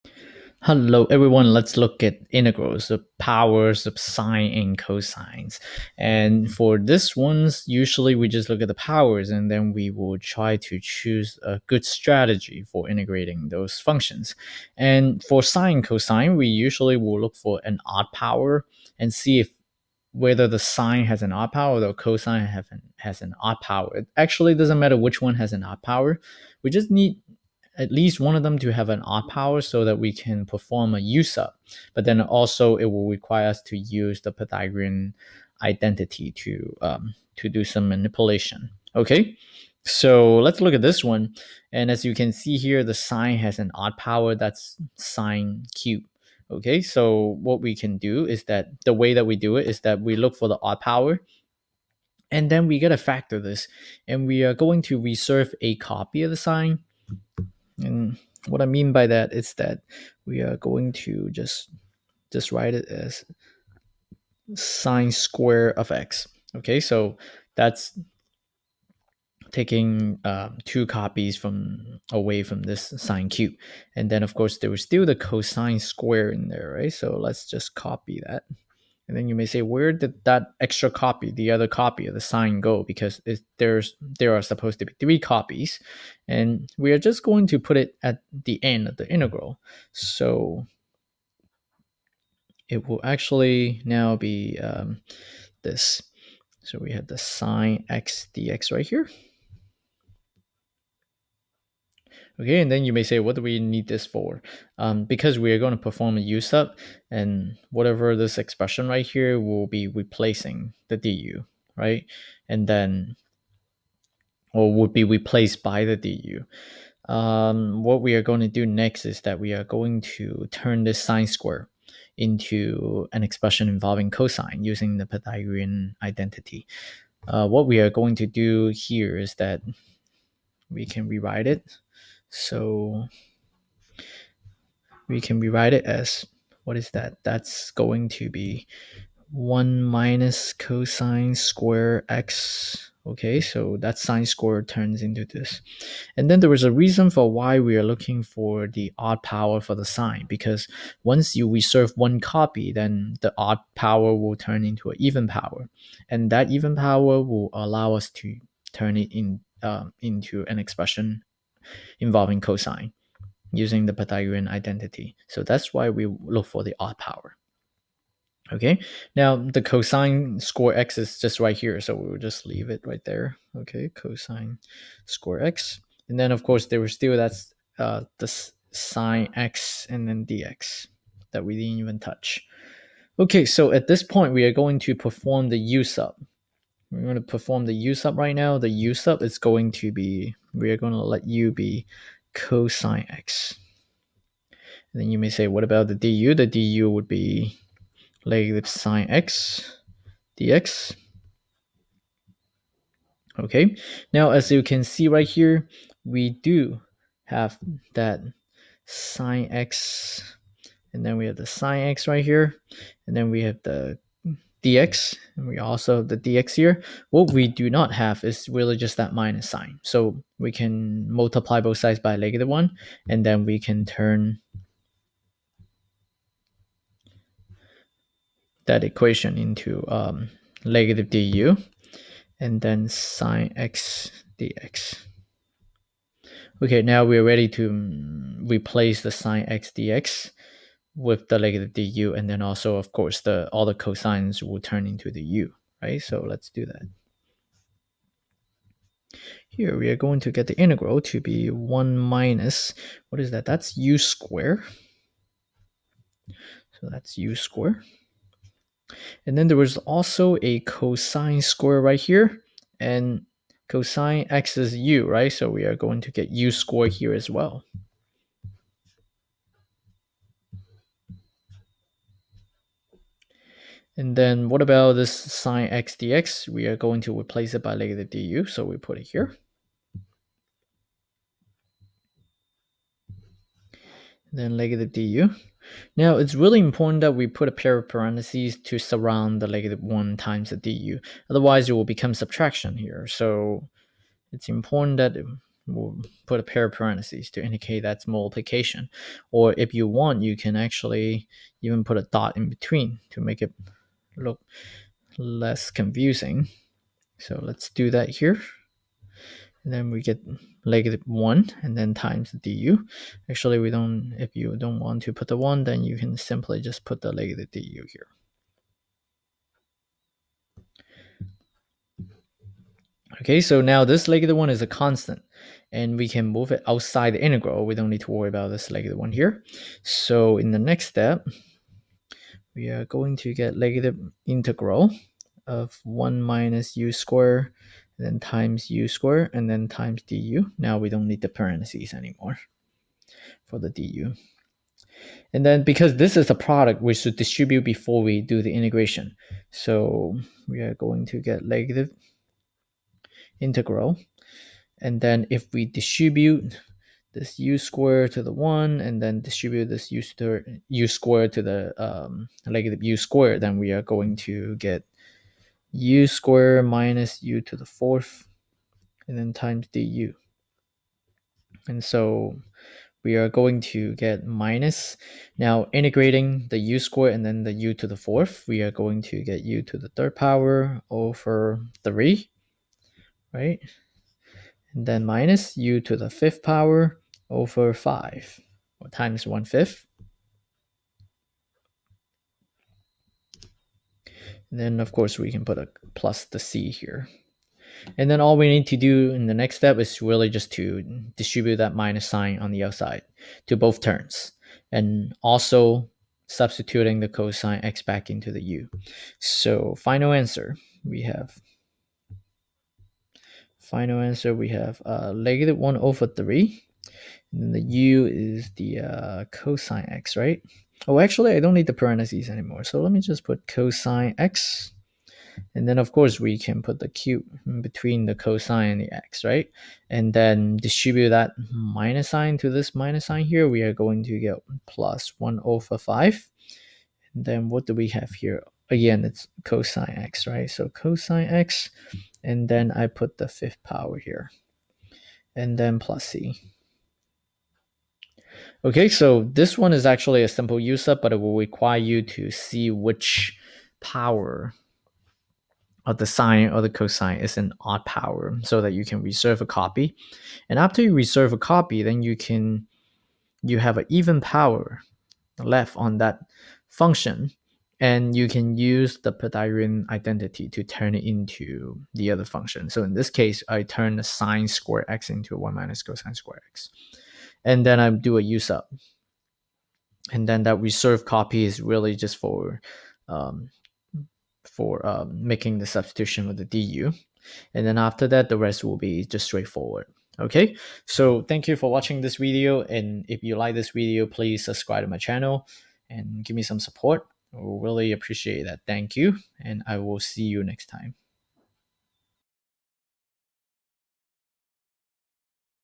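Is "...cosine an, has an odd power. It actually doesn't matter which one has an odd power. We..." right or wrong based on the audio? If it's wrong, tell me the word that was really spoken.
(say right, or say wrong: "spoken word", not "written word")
right.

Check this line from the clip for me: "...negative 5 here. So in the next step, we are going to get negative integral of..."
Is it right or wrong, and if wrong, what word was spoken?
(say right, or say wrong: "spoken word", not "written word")
wrong: "1", not "5".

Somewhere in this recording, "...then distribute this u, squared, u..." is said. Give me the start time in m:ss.
5:59.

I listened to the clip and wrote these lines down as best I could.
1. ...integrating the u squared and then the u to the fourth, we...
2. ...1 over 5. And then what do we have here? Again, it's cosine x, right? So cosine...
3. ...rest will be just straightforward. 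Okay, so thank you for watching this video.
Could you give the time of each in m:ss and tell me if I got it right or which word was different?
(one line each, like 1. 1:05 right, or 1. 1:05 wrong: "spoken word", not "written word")
1. 6:15 right
2. 7:15 right
3. 8:08 right.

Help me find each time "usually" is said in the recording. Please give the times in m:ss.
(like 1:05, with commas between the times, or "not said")
0:07, 0:16.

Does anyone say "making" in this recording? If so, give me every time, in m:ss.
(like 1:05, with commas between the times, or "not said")
8:05.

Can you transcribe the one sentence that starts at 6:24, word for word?
And then minus u to the fifth power over 5 or times 1 fifth.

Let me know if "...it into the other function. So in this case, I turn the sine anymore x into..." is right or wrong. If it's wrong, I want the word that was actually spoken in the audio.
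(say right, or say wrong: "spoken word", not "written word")
wrong: "square", not "anymore".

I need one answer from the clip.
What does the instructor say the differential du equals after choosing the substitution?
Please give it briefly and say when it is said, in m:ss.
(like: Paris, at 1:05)
negative sine x dx, at 3:18.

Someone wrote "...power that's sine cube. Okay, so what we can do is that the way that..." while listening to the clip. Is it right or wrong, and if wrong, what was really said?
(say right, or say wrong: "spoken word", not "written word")
right.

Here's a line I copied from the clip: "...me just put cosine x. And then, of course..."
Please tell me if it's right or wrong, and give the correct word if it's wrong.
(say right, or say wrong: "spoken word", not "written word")
right.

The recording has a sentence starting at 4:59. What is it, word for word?
Or if you want, you can actually even put a dot in between to make it look less confusing.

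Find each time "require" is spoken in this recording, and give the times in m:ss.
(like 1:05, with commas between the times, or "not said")
0:33, 7:31.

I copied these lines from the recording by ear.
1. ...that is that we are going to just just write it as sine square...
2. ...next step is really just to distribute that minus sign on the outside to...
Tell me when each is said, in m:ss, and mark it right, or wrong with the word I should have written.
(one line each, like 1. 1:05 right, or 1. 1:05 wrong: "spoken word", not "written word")
1. 0:59 right
2. 6:39 right.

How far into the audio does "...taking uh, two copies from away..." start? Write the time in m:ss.
1:09.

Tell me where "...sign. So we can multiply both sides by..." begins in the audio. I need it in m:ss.
3:39.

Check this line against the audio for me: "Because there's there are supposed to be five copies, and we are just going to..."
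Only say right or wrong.
wrong.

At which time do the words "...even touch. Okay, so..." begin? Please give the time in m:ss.
3:01.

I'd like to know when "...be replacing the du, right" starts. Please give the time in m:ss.
1:49.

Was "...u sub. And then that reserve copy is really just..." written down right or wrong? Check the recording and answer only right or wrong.
right.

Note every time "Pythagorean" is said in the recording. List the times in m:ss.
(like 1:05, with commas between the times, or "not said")
0:34, 2:05, 2:43, 7:49.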